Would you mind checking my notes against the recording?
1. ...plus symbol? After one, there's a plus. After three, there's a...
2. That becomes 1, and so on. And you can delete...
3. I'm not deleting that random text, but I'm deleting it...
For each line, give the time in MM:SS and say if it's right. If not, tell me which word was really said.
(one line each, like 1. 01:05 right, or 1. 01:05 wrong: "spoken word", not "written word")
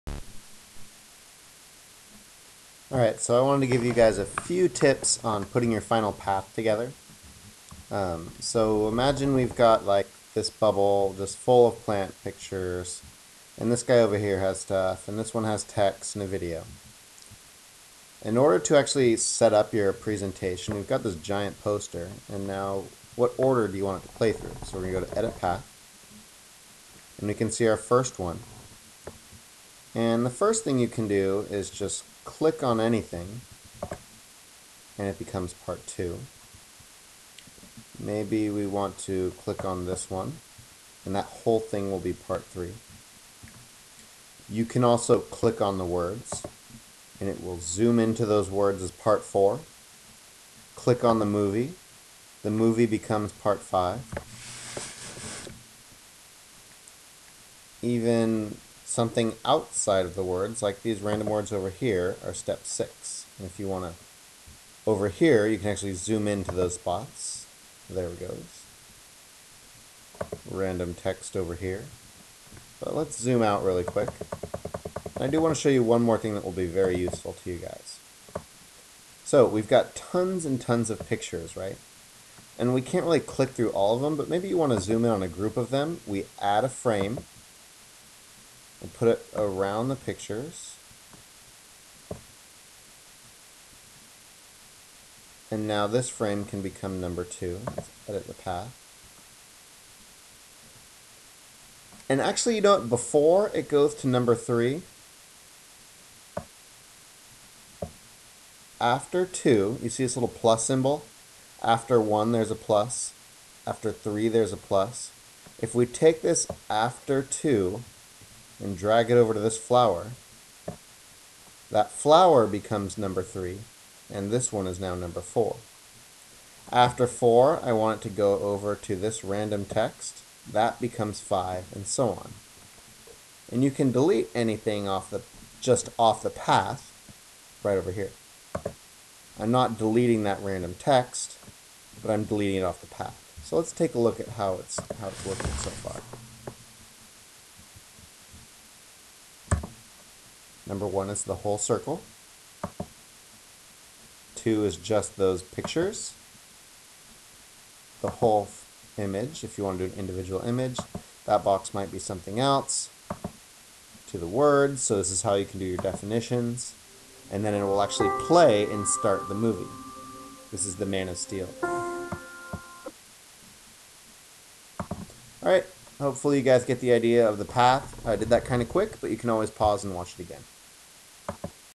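1. 01:50 right
2. 02:10 wrong: "5", not "1"
3. 02:19 right.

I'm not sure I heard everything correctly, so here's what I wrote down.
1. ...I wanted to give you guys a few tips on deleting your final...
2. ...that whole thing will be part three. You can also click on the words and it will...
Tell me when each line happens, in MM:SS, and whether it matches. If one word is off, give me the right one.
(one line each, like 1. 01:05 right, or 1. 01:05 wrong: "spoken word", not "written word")
1. 00:03 wrong: "putting", not "deleting"
2. 00:41 right.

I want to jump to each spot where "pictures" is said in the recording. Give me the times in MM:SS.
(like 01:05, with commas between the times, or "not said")
00:12, 01:21, 01:29, 02:35.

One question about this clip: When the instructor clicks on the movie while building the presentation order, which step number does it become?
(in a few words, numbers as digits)
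5.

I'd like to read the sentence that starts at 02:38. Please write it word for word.
The whole image, if you want to do an individual image.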